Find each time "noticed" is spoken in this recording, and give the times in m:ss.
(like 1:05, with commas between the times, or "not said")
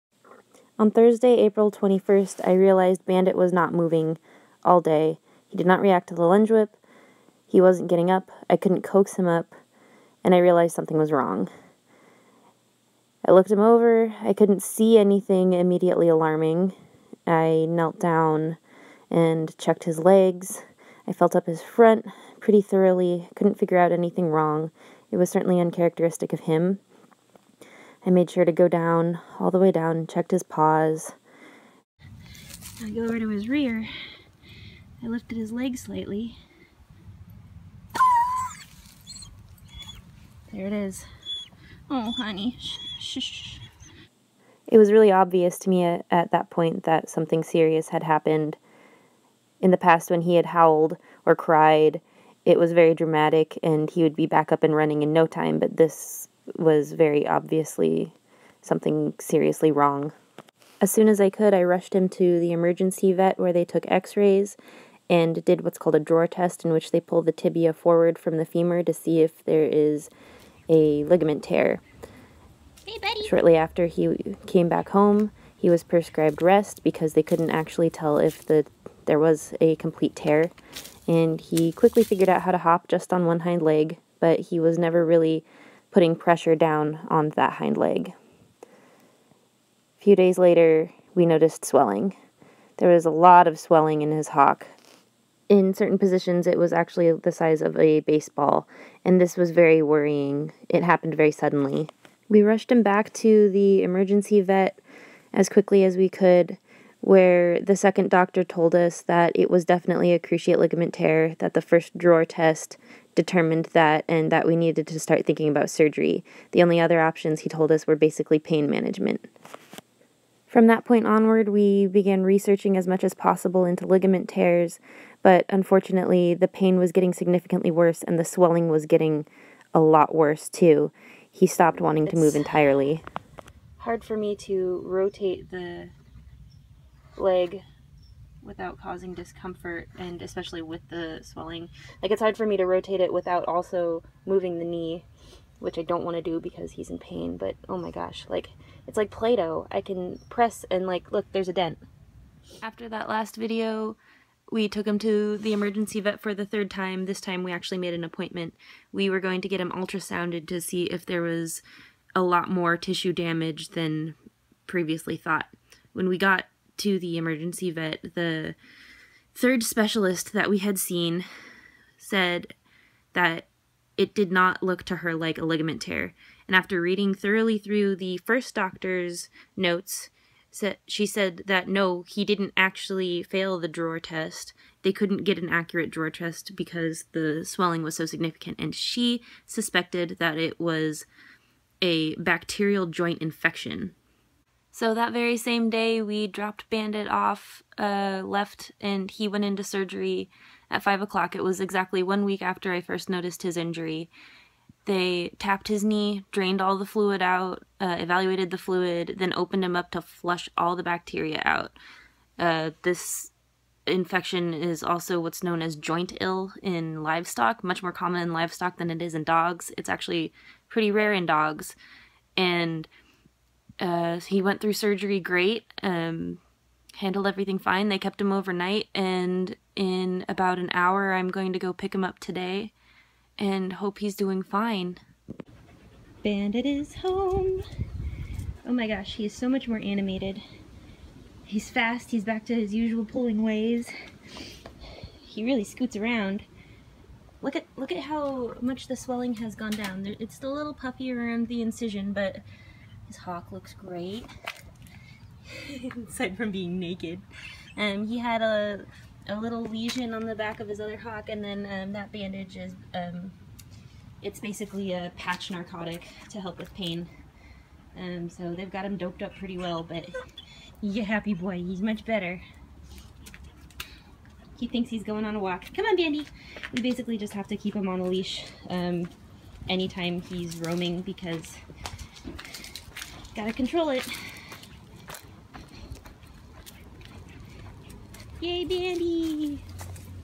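1:31, 3:23.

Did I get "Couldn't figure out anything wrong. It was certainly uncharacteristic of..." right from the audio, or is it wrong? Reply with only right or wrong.
right.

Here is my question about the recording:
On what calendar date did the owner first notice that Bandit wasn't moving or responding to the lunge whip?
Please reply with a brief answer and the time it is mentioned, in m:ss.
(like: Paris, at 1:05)
April 21, at 0:01.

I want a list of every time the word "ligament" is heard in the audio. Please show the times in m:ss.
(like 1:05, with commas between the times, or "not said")
1:11, 1:50, 2:03, 2:55.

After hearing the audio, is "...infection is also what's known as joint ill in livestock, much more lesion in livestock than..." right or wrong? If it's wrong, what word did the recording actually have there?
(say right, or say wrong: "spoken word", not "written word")
wrong: "common", not "lesion".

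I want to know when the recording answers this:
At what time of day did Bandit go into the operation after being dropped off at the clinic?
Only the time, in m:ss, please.
3:20.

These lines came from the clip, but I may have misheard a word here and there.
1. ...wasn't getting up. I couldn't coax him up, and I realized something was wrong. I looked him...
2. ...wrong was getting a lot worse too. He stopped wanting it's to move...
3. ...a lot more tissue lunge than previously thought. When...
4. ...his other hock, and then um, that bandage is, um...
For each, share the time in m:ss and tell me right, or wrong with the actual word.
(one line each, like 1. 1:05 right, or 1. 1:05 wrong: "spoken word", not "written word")
1. 0:07 right
2. 2:08 wrong: "swelling", not "wrong"
3. 2:42 wrong: "damage", not "lunge"
4. 4:20 right.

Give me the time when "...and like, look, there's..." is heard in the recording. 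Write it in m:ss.
2:30.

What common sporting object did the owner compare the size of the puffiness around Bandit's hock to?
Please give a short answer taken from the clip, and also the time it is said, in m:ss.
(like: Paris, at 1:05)
a baseball, at 1:37.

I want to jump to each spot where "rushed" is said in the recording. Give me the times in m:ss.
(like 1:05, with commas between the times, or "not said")
1:01, 1:42.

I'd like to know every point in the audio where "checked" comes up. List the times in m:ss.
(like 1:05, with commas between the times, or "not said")
0:19, 0:30.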